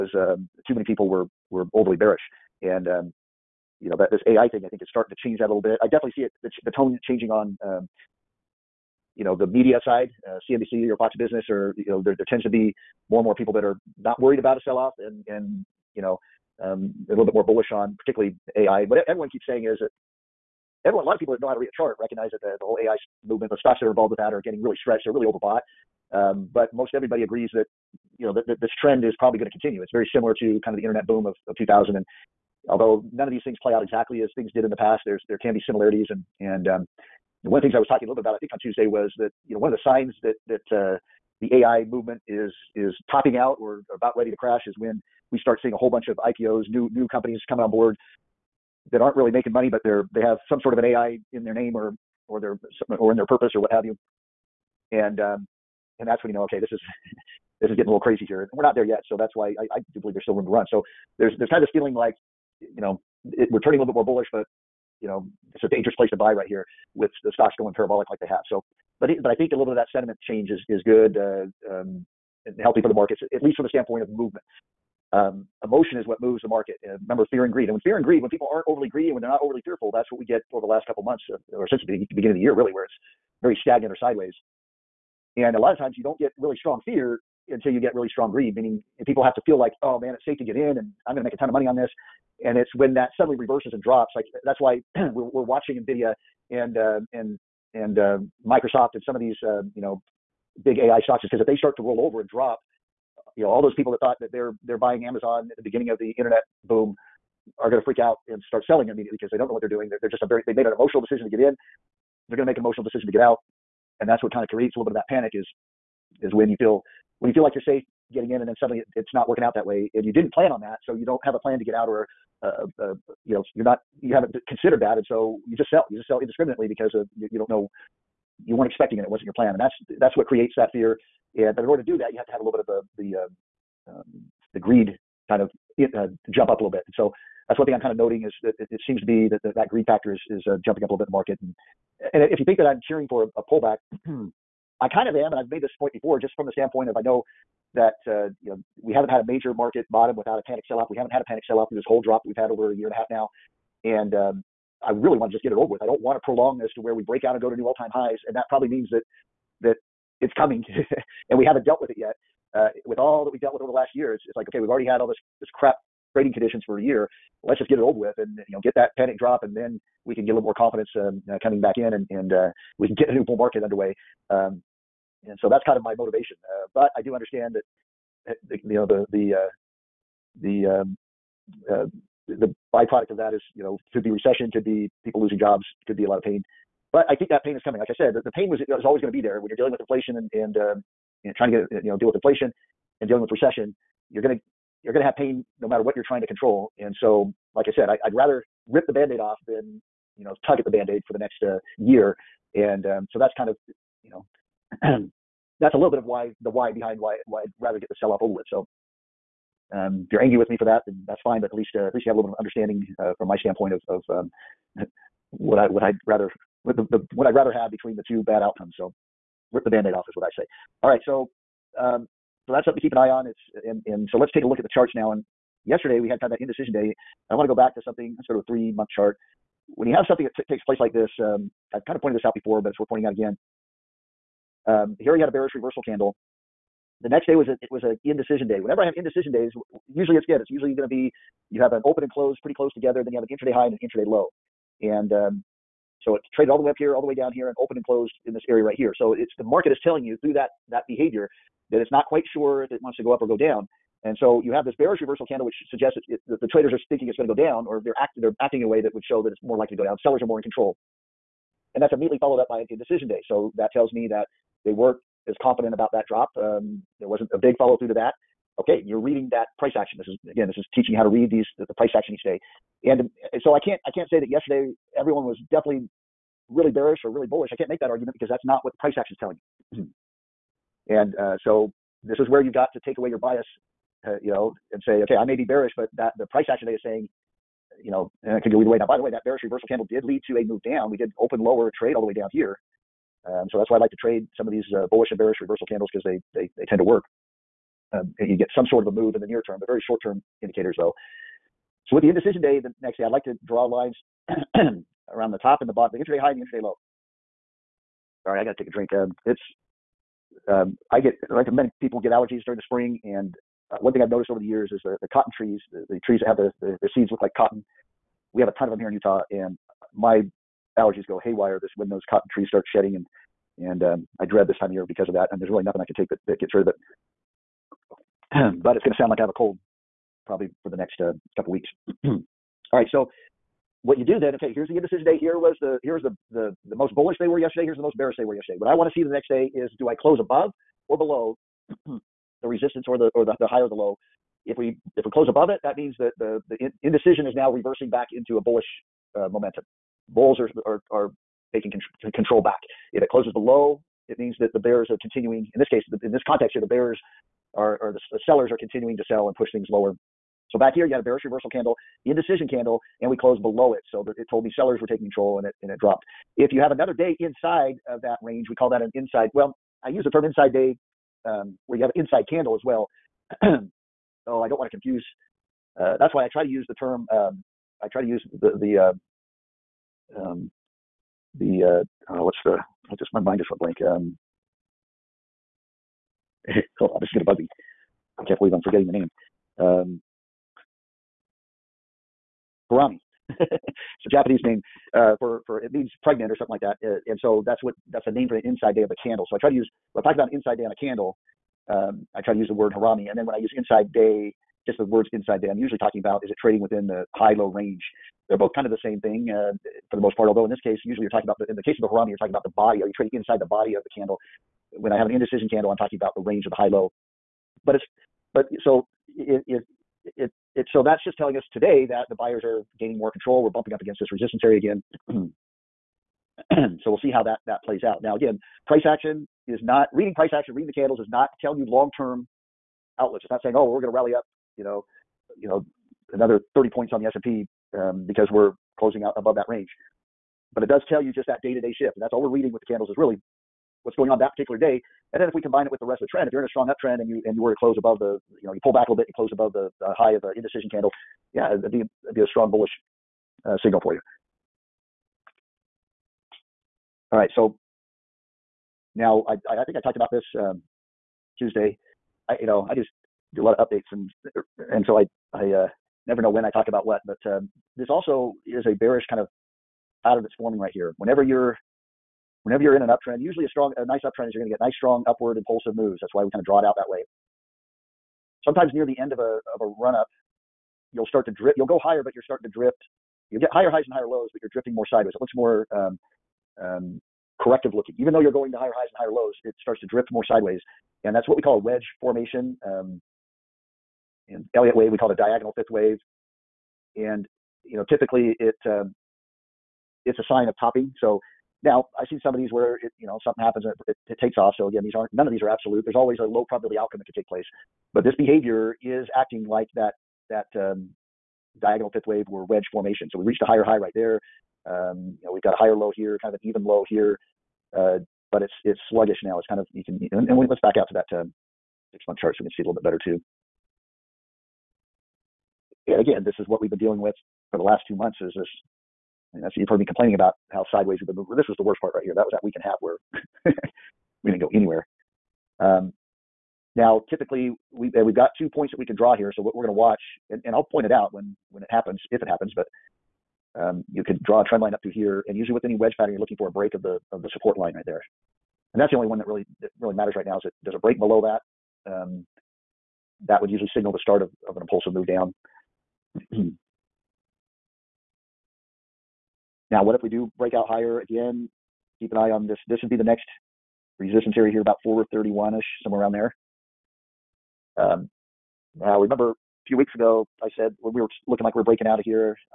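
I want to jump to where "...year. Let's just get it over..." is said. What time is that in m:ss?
2:46.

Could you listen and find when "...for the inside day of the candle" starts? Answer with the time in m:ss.
6:38.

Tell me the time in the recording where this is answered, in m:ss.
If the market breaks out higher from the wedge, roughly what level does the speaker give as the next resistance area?
9:24.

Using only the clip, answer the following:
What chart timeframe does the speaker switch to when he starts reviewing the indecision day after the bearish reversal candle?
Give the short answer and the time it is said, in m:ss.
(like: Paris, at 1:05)
Three month, at 3:48.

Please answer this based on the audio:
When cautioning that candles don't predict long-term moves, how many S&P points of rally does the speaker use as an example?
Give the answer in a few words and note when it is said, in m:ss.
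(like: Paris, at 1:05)
30, at 7:16.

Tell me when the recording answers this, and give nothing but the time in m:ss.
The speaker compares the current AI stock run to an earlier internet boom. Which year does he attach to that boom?
0:31.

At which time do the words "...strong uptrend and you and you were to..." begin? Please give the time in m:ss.
7:26.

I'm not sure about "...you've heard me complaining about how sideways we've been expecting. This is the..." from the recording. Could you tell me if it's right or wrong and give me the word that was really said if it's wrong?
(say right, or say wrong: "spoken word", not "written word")
wrong: "moving", not "expecting".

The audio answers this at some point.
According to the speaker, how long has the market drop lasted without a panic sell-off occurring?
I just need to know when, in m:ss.
2:32.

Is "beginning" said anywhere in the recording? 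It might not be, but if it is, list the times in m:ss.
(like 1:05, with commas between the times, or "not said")
1:22, 1:45.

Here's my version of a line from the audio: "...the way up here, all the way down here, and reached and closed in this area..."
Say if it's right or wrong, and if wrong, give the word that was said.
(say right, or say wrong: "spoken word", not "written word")
wrong: "opened", not "reached".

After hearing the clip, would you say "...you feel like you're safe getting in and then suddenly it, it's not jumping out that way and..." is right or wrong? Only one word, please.
wrong.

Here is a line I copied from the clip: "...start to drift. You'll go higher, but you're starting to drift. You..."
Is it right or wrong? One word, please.
right.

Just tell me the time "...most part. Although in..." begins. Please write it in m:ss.
6:49.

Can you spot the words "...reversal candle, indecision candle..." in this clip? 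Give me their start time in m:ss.
6:01.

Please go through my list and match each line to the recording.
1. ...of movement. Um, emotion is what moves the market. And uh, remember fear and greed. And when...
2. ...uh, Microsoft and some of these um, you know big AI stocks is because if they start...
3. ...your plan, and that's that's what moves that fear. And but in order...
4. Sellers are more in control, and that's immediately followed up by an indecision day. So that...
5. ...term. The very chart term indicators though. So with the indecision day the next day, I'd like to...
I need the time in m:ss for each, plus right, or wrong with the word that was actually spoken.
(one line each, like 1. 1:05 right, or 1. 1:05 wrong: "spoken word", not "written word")
1. 1:14 right
2. 1:37 right
3. 2:09 wrong: "creates", not "moves"
4. 4:20 right
5. 4:59 wrong: "short", not "chart".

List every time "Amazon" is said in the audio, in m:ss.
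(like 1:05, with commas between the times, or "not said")
1:45.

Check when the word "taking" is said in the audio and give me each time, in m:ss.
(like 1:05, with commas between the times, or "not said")
5:51, 6:04.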